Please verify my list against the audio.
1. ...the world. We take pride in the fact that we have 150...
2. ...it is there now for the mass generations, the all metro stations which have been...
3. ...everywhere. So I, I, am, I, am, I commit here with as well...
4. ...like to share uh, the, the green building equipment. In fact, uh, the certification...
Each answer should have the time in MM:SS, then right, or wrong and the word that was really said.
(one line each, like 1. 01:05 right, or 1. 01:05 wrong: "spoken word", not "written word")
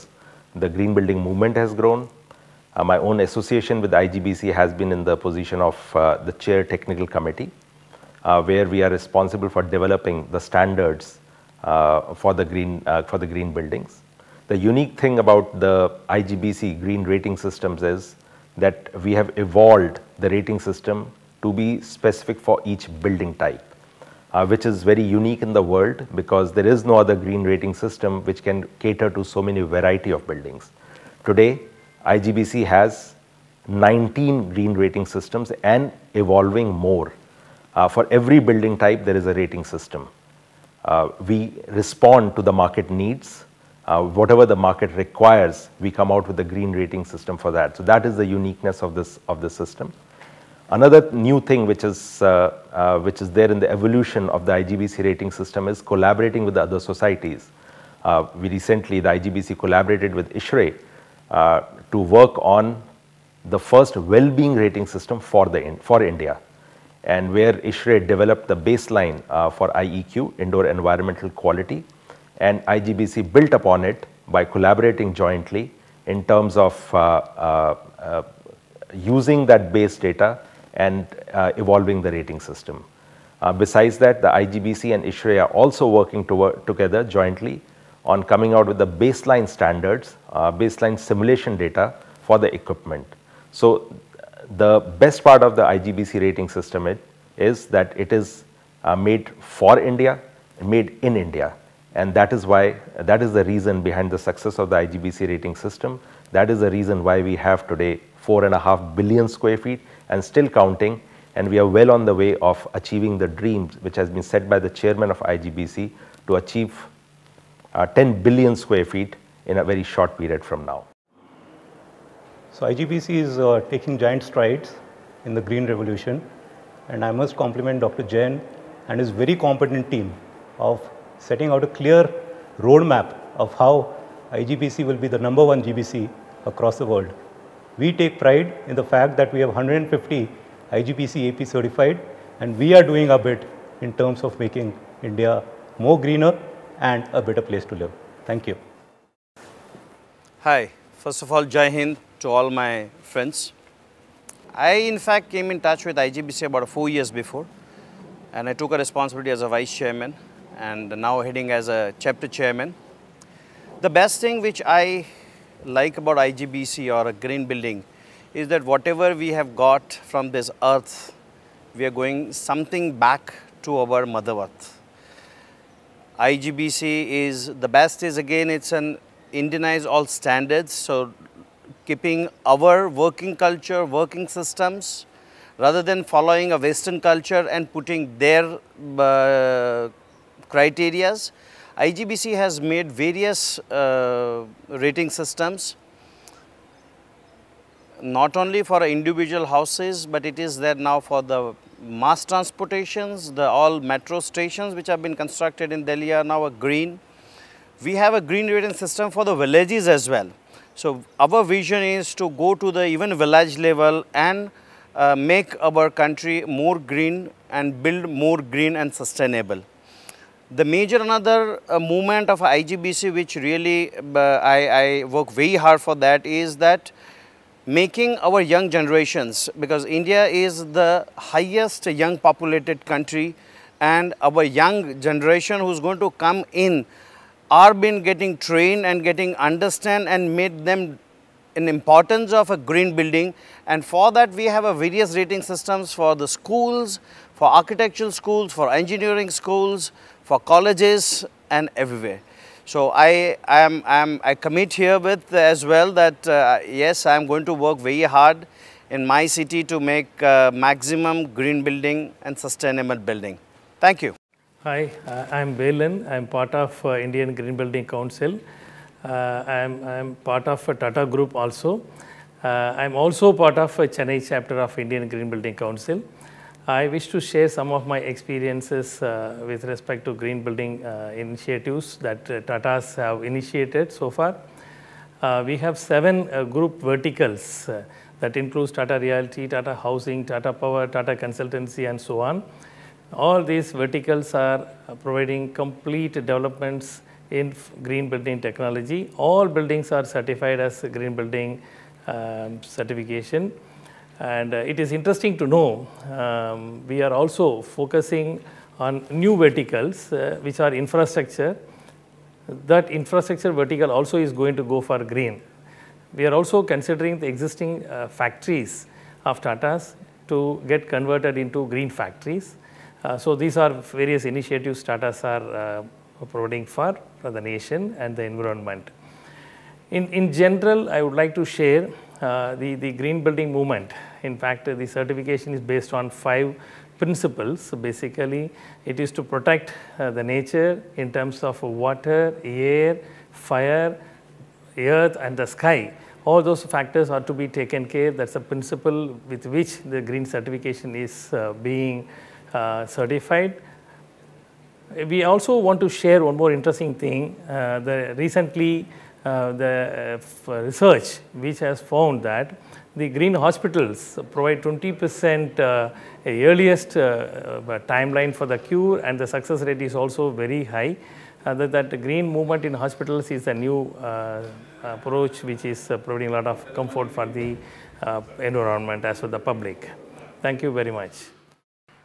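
1. 02:16 right
2. 03:20 wrong: "transportations", not "generations"
3. 04:11 right
4. 05:31 wrong: "movement", not "equipment".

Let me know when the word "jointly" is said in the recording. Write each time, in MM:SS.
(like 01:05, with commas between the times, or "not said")
01:15, 01:27.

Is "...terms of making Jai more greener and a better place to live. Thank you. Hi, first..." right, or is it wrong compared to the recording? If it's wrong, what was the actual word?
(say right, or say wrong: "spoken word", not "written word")
wrong: "India", not "Jai".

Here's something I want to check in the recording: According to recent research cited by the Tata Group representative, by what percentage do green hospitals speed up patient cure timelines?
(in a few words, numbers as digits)
20 percent.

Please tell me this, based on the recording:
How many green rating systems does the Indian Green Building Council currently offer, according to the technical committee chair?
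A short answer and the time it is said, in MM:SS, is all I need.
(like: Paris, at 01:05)
19, at 00:33.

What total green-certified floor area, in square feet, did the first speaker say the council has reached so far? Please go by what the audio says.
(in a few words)
4.5 billion square feet.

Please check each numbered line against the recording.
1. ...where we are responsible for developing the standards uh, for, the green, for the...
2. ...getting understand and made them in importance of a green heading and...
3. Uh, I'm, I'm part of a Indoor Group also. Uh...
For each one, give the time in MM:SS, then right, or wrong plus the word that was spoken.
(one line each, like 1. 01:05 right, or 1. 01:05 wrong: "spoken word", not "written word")
1. 00:08 right
2. 03:59 wrong: "building", not "heading"
3. 04:29 wrong: "Tata", not "Indoor".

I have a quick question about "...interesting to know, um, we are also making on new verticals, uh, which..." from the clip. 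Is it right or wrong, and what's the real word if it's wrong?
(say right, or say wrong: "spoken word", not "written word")
wrong: "focusing", not "making".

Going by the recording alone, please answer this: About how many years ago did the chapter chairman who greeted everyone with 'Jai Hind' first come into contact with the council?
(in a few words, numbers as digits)
4 years.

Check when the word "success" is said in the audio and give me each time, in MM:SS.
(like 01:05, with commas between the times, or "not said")
01:44, 06:09.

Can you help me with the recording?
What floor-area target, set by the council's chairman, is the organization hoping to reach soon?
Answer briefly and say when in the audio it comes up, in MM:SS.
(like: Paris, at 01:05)
10 billion square feet, at 01:57.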